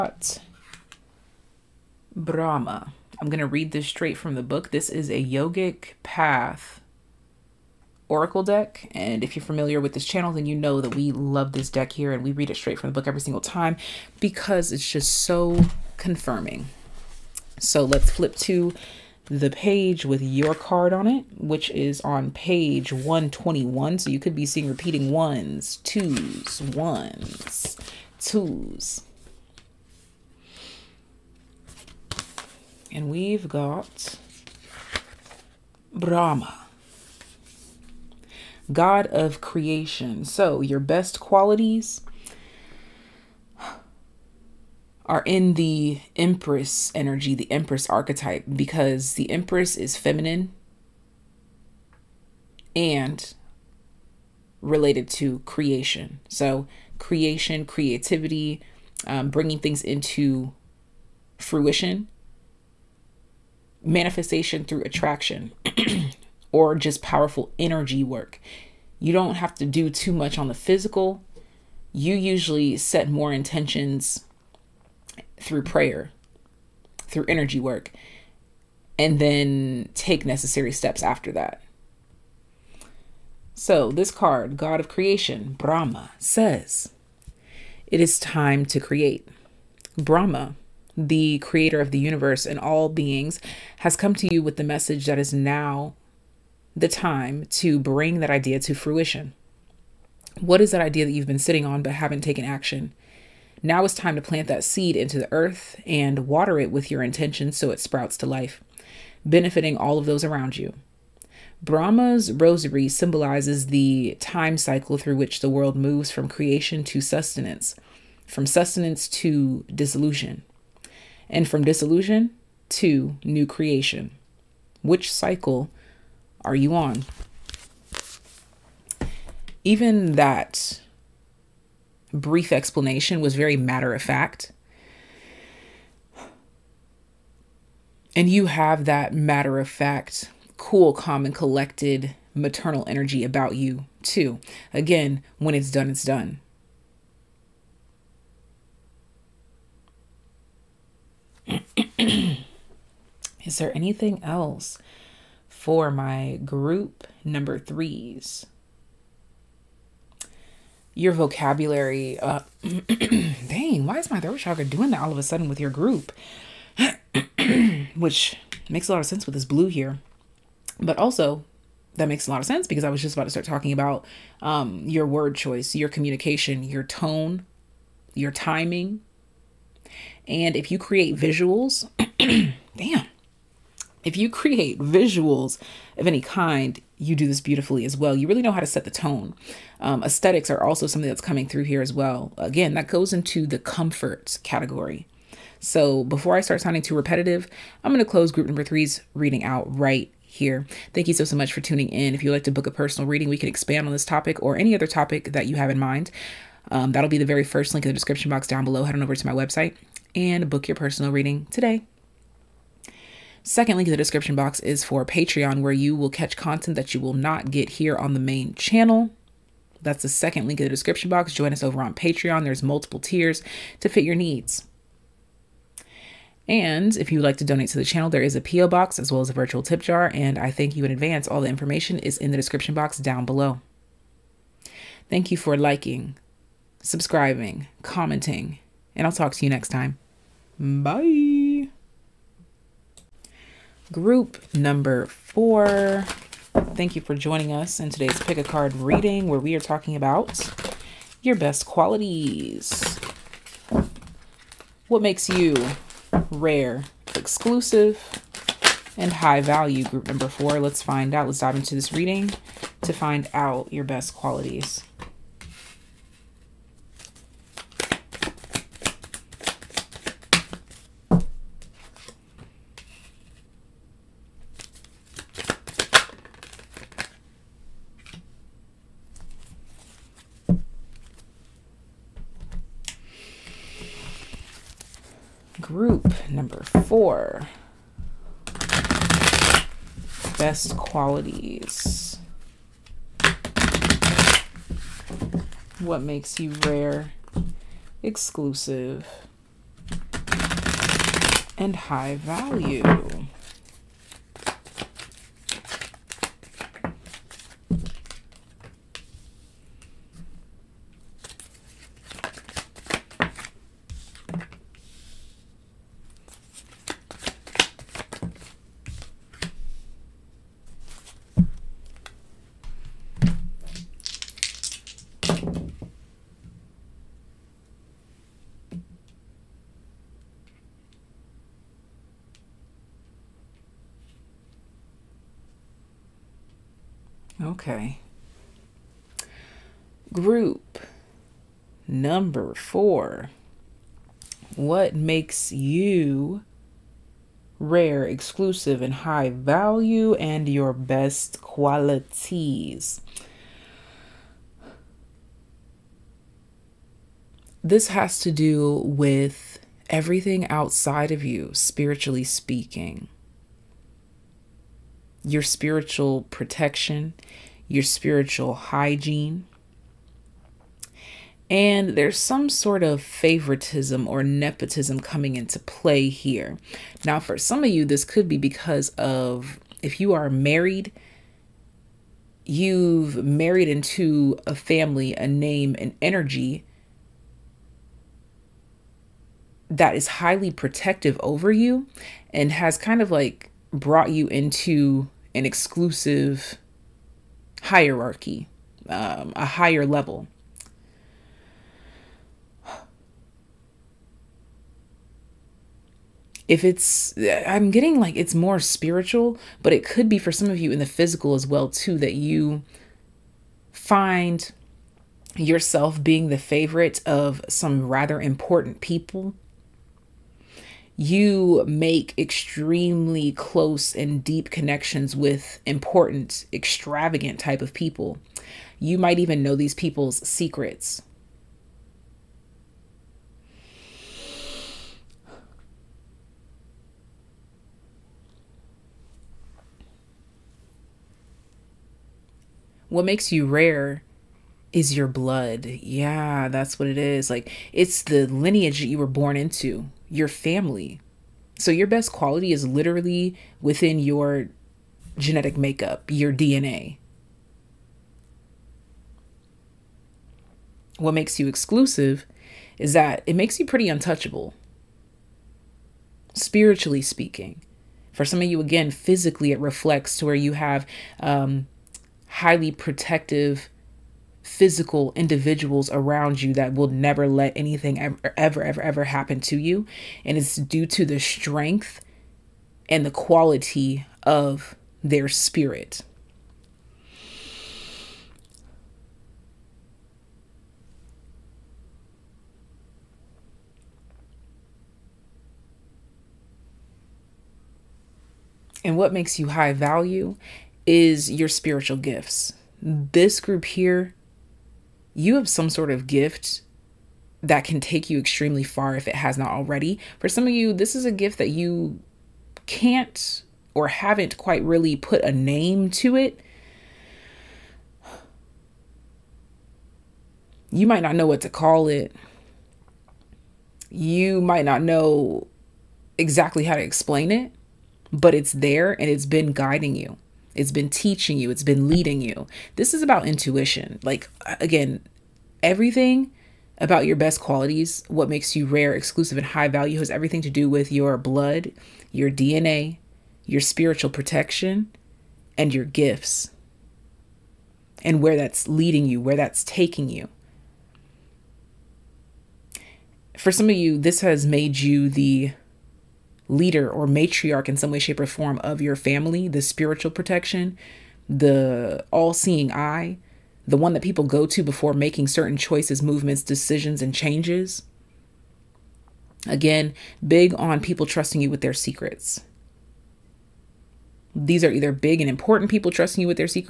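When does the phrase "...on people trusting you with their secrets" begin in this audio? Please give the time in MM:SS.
09:30.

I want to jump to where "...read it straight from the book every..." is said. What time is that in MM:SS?
00:12.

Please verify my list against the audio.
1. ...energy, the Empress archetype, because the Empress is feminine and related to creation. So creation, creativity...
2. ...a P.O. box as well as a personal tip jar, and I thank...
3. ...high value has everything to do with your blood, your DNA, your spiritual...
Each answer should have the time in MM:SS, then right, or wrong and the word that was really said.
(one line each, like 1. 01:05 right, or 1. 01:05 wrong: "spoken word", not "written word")
1. 00:46 right
2. 03:48 wrong: "virtual", not "personal"
3. 08:59 right.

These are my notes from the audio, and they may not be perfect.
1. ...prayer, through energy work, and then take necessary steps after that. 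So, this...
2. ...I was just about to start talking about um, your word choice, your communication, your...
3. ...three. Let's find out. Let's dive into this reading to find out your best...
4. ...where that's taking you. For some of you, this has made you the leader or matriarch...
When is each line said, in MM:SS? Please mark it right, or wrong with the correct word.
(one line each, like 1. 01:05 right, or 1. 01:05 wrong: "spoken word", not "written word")
1. 01:15 right
2. 02:52 right
3. 04:20 wrong: "four", not "three"
4. 09:09 right.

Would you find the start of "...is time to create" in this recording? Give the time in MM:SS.
01:28.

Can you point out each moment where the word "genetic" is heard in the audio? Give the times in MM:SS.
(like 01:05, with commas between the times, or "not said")
07:35.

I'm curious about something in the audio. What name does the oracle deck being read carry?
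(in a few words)
Yogic path oracle deck.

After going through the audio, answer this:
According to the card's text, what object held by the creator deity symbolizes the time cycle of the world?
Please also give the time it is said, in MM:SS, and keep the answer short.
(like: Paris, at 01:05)
Rosary, at 01:52.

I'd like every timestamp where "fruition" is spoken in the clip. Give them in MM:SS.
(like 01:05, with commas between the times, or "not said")
01:01, 01:38.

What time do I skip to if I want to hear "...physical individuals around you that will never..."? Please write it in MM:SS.
07:54.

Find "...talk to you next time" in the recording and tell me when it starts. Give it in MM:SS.
03:59.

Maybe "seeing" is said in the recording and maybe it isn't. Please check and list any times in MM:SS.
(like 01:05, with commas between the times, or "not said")
00:24, 09:22.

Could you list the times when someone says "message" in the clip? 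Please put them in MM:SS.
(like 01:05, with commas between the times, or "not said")
01:34.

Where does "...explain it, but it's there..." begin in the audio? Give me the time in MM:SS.
08:46.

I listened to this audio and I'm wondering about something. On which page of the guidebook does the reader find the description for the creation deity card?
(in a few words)
121.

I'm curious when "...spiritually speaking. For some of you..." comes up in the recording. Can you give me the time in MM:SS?
07:46.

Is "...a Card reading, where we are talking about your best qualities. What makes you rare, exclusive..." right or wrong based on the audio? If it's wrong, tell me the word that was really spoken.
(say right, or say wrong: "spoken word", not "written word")
right.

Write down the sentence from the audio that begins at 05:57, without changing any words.
This has to do with everything outside of you, spiritually speaking.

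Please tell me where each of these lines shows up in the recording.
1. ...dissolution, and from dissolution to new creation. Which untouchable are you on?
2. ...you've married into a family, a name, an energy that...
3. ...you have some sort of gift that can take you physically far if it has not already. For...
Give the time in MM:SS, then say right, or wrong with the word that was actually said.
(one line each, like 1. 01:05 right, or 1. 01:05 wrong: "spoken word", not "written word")
1. 01:59 wrong: "cycle", not "untouchable"
2. 06:22 right
3. 08:25 wrong: "extremely", not "physically".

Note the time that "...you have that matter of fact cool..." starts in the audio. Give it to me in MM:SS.
02:18.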